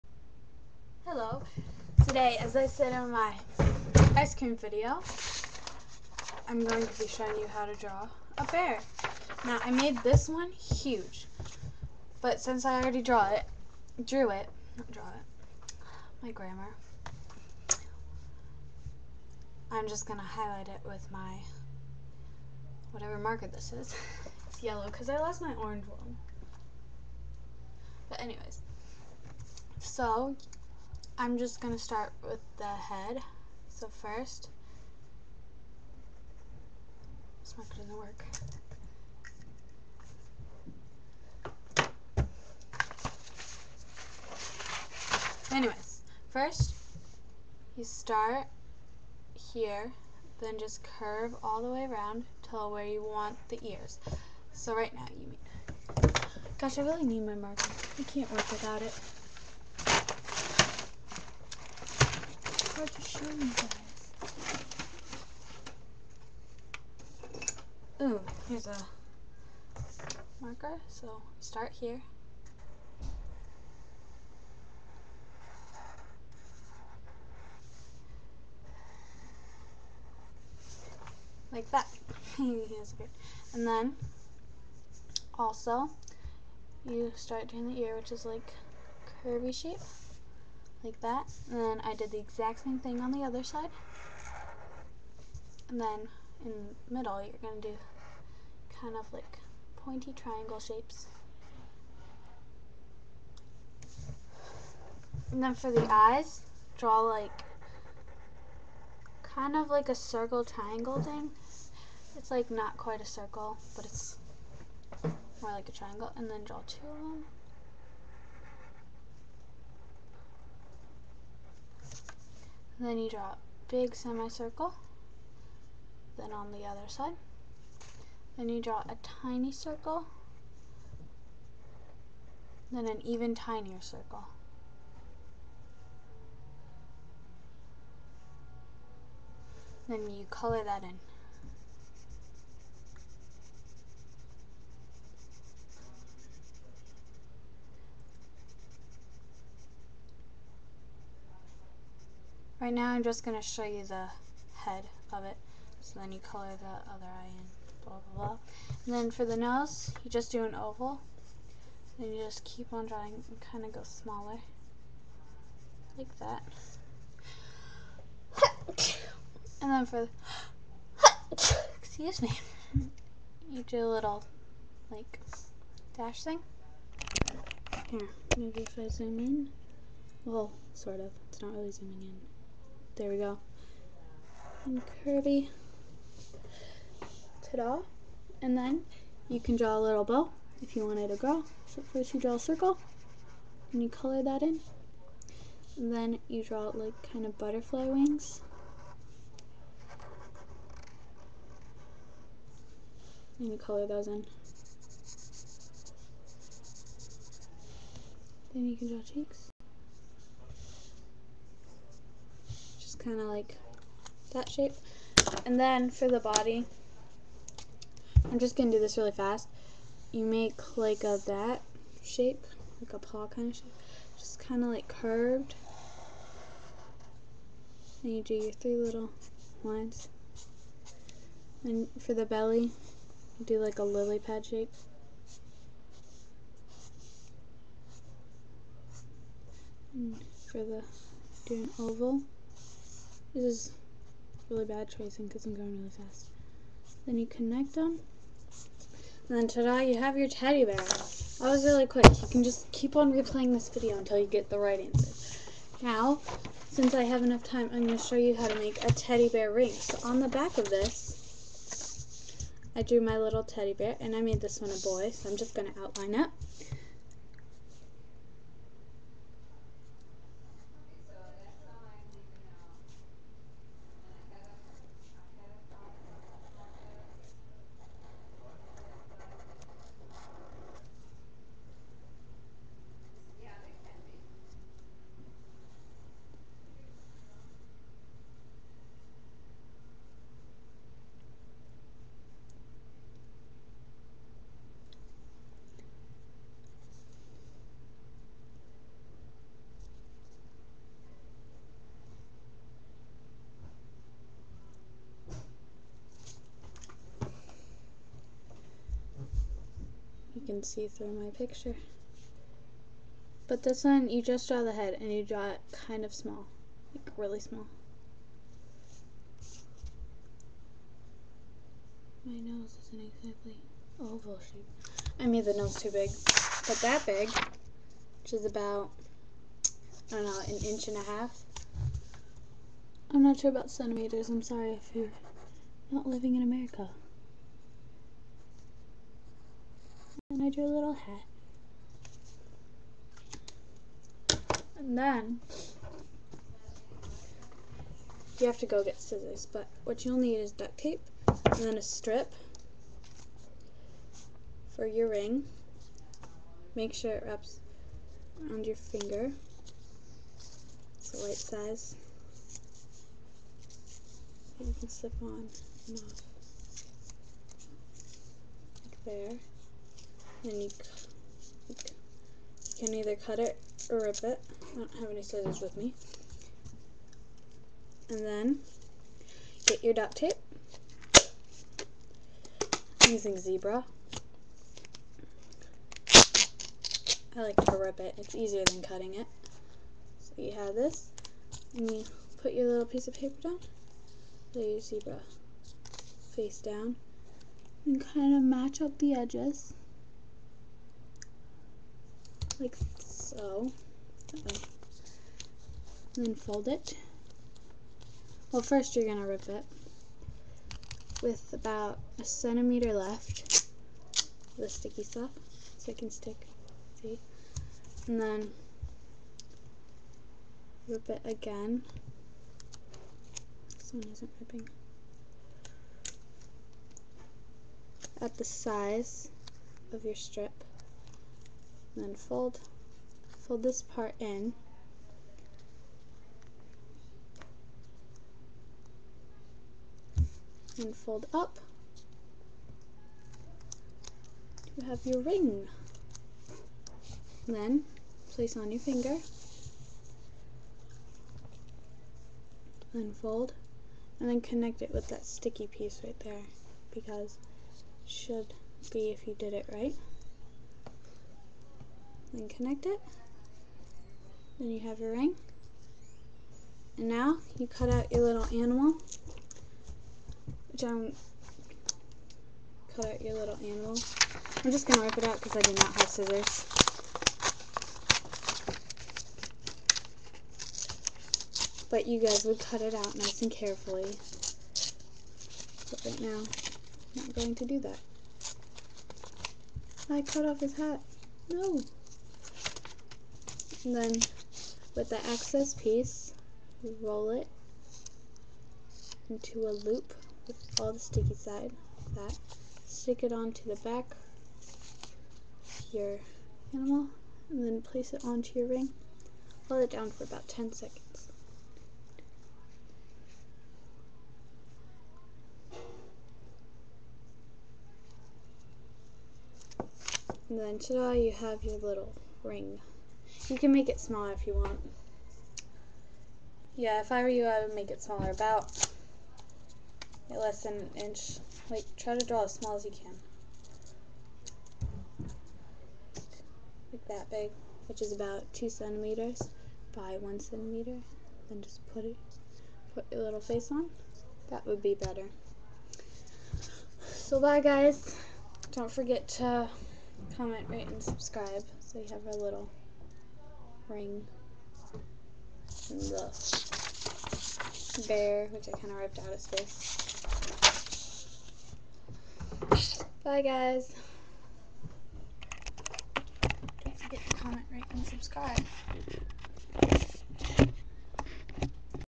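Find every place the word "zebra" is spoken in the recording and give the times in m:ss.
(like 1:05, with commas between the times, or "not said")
6:23, 6:34.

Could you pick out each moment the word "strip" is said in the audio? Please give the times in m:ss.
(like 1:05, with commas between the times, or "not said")
5:51, 7:10.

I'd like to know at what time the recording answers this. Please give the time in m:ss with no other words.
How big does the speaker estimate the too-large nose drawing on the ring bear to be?
5:30.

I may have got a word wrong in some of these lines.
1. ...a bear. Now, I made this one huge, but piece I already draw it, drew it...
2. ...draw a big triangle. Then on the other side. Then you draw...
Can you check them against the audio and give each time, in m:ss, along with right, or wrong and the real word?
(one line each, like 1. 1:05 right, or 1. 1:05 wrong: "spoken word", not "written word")
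1. 0:08 wrong: "since", not "piece"
2. 2:03 wrong: "semicircle", not "triangle".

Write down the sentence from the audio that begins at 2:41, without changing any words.
Then you just keep on drawing and kind of go smaller.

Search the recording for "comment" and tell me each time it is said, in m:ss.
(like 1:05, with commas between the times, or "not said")
9:10, 9:27.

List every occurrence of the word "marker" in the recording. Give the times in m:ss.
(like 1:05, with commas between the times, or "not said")
0:23, 0:37, 0:57, 1:10.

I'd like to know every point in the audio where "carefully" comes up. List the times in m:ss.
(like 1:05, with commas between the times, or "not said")
8:03.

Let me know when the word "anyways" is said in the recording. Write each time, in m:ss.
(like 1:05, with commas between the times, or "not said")
0:28, 0:45.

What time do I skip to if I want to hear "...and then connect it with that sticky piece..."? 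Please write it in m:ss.
7:34.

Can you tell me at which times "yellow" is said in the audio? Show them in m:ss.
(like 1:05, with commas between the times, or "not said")
0:24.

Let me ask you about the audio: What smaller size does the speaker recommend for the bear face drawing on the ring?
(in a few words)
2 centimeters by 1 centimeter.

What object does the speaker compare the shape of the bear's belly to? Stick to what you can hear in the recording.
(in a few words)
lily pad.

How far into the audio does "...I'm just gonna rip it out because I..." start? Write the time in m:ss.
7:54.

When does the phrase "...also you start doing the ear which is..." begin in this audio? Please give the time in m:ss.
1:25.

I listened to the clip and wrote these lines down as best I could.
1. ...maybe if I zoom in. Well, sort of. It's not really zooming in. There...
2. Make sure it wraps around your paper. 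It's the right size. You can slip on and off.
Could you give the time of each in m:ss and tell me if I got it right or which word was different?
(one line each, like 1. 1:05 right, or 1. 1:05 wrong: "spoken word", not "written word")
1. 2:58 right
2. 5:56 wrong: "finger", not "paper".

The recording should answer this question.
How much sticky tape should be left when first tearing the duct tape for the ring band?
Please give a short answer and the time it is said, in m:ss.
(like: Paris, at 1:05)
1 centimeter, at 6:52.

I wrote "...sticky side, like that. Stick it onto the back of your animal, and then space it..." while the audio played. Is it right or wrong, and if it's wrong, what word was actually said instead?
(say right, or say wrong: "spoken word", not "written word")
wrong: "place", not "space".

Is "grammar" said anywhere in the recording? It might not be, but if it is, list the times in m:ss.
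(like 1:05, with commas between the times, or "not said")
0:16.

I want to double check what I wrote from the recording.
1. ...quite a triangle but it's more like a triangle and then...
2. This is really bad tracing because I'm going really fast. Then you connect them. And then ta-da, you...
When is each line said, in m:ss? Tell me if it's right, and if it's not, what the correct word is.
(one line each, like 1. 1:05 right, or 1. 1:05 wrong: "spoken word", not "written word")
1. 1:52 wrong: "circle", not "triangle"
2. 4:03 right.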